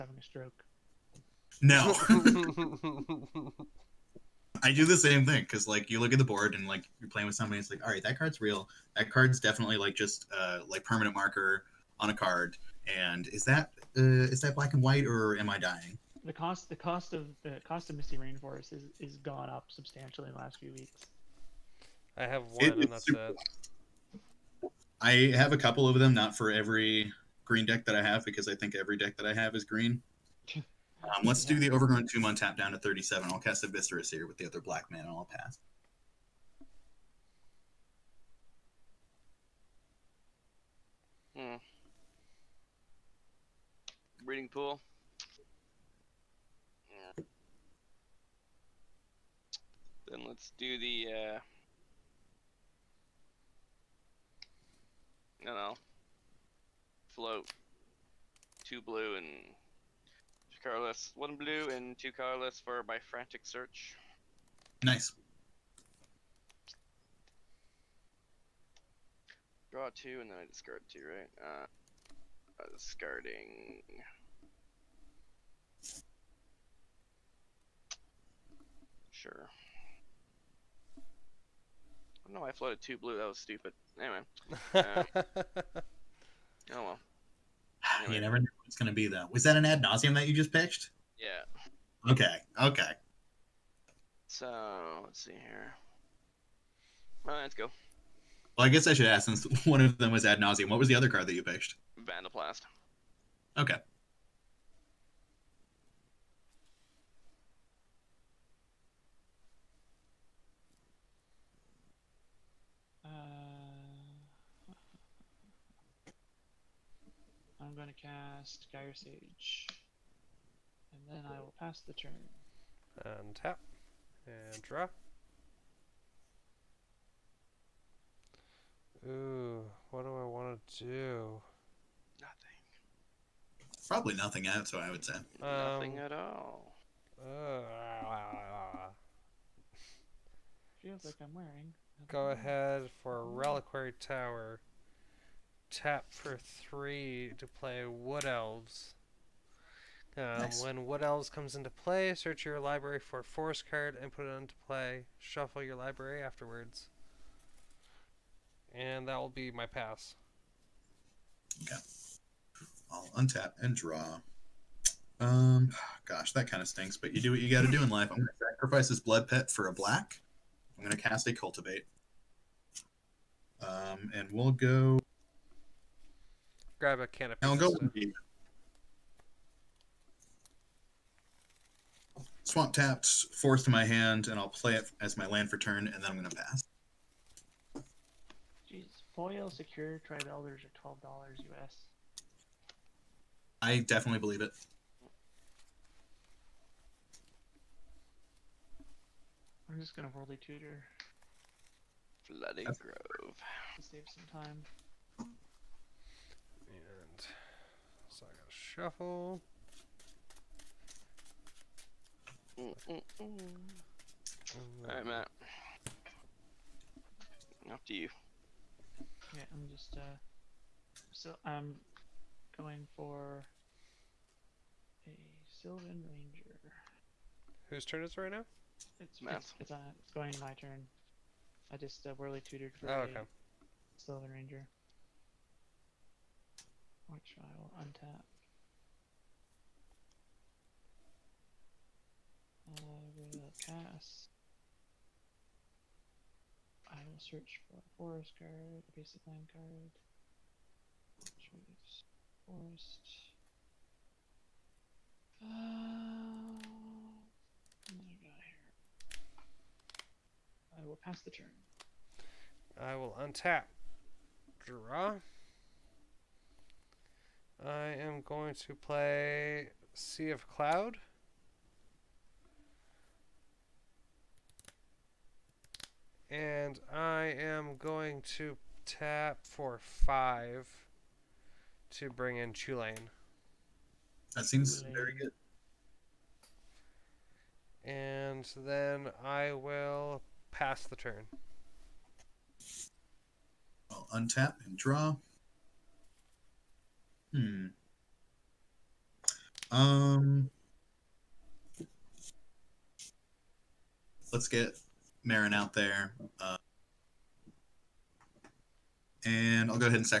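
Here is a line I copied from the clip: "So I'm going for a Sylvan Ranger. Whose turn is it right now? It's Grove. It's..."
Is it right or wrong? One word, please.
wrong.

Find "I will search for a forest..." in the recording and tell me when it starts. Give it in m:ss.
4:06.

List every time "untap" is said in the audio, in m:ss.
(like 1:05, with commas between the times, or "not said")
2:43, 3:57, 4:23, 4:54.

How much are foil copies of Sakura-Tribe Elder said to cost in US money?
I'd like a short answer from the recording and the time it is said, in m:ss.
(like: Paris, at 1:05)
12 dollars, at 3:10.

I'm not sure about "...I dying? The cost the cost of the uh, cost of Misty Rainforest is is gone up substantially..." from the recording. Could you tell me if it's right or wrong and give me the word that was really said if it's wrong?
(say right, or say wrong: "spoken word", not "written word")
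right.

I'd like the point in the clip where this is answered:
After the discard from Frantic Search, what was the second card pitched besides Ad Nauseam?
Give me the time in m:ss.
1:42.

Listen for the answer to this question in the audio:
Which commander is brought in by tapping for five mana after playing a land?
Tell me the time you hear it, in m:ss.
4:42.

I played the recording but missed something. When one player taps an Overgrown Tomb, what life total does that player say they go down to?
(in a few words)
37.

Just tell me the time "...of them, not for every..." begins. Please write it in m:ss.
0:25.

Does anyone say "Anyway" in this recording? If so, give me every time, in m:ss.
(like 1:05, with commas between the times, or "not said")
1:24, 1:28.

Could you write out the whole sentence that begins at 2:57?
I'll go Swamp taps, fourth to my hand, and I'll play it as my land for turn, and then I'm gonna pass.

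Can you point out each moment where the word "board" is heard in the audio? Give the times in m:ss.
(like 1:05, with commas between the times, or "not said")
0:06.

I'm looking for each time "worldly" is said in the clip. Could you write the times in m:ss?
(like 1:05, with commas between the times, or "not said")
3:20, 3:52.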